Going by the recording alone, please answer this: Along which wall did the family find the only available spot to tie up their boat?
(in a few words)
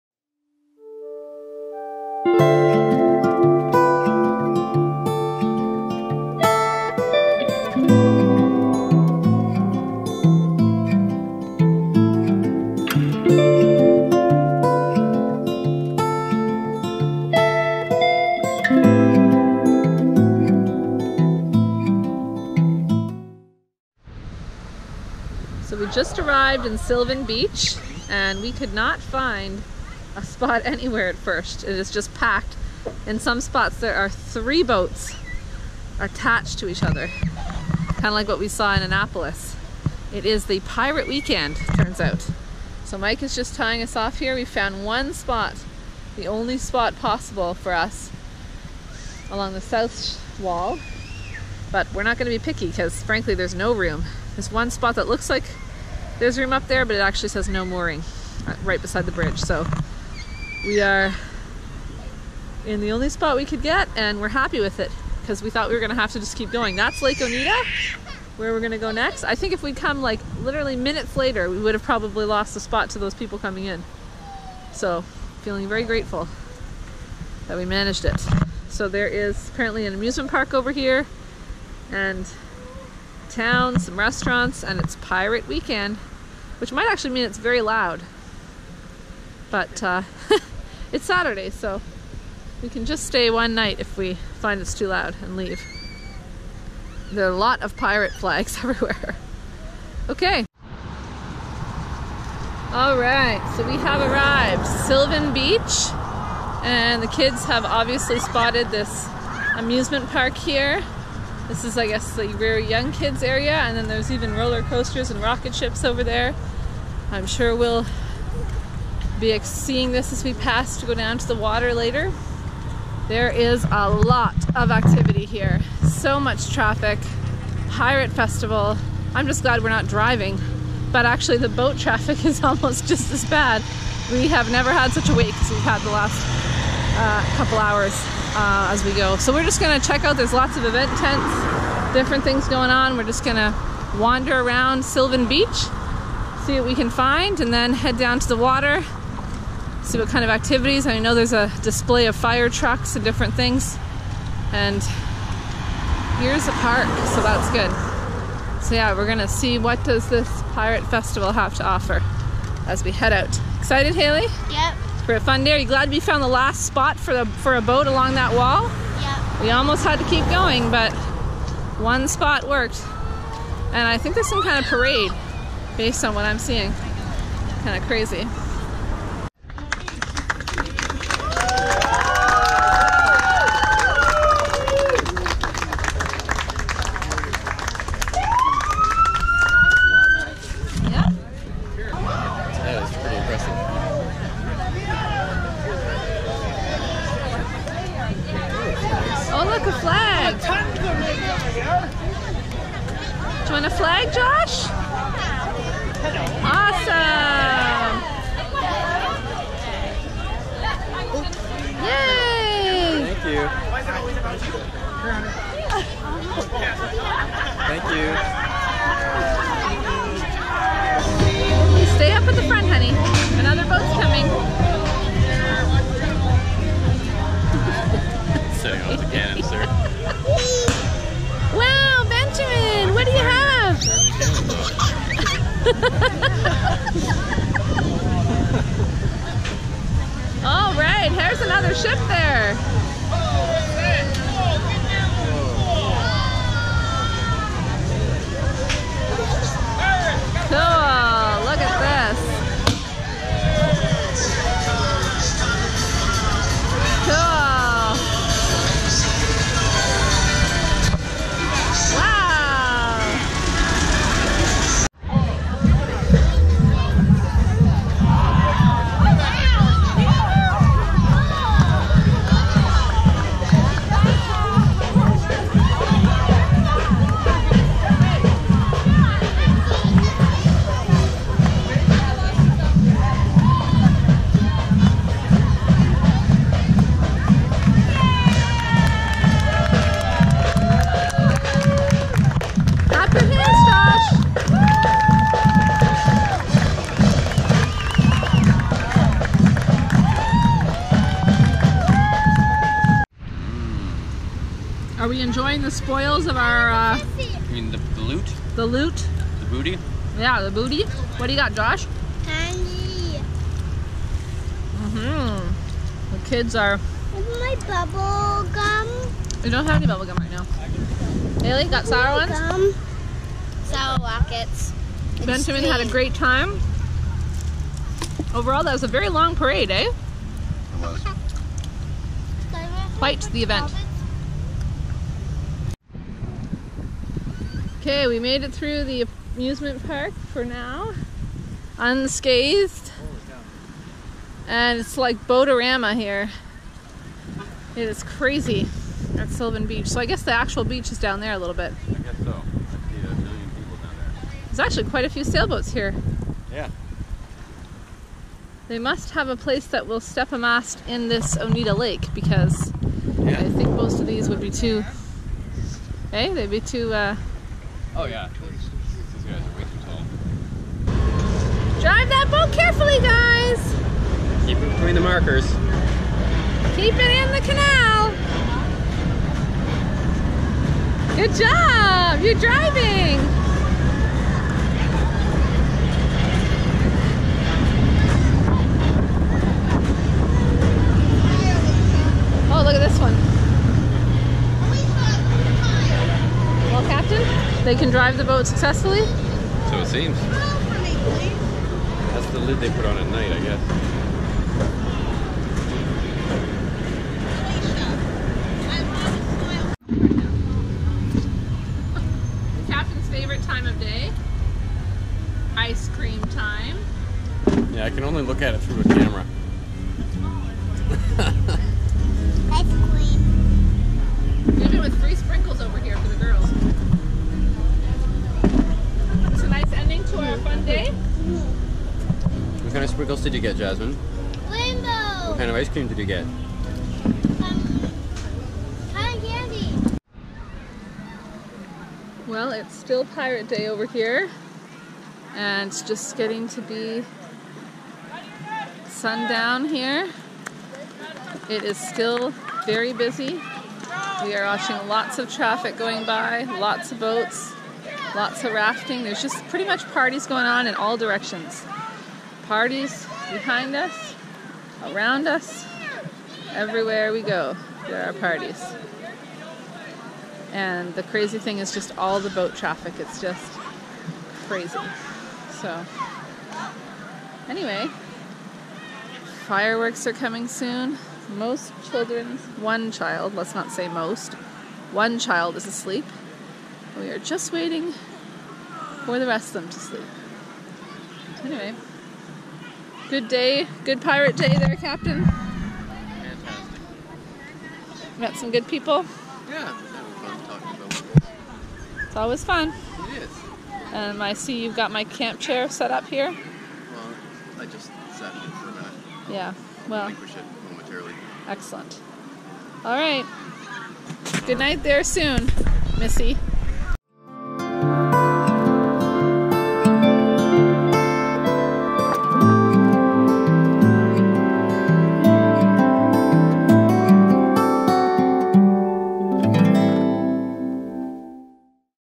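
South wall.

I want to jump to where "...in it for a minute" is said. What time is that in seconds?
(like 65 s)
508 s.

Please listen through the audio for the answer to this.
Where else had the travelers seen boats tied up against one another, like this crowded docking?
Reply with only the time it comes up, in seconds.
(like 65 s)
38 s.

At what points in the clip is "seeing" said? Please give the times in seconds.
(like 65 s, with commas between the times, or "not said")
119 s, 176 s.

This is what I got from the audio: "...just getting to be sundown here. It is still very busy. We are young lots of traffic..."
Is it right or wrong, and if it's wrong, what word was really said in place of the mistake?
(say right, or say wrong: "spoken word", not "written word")
wrong: "watching", not "young".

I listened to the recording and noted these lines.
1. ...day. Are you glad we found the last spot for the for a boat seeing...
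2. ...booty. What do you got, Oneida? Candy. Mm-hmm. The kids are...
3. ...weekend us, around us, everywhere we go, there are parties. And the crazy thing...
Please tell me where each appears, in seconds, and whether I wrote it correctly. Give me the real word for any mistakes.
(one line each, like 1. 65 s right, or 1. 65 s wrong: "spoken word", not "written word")
1. 165 s wrong: "along", not "seeing"
2. 310 s wrong: "Josh", not "Oneida"
3. 463 s wrong: "behind", not "weekend".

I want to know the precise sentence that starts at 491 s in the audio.
Anyway, good day, good pirate day there, Captain.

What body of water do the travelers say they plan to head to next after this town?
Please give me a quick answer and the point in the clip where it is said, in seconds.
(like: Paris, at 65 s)
Lake Oneida, at 67 s.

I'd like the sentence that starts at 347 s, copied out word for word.
It is crazy at Sylvan Beach.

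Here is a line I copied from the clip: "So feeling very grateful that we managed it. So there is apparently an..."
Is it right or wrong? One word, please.
right.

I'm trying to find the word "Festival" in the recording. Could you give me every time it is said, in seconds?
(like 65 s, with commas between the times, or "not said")
128 s, 160 s.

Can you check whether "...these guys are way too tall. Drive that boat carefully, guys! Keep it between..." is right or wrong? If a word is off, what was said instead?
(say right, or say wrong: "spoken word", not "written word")
right.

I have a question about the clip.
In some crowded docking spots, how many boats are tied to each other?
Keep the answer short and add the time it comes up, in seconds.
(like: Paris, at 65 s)
3, at 34 s.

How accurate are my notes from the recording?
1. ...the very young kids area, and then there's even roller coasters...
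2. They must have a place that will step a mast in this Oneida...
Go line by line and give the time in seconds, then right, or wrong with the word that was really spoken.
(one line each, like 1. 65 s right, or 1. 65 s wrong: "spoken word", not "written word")
1. 112 s right
2. 358 s right.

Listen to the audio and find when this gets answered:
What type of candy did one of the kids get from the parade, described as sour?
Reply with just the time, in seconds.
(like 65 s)
323 s.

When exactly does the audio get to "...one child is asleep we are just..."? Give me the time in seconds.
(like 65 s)
484 s.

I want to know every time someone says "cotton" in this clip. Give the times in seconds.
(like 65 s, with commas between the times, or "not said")
437 s.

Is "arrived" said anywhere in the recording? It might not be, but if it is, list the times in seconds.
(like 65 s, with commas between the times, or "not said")
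26 s, 103 s.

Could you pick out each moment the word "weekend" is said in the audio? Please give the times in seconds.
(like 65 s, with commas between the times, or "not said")
41 s, 85 s.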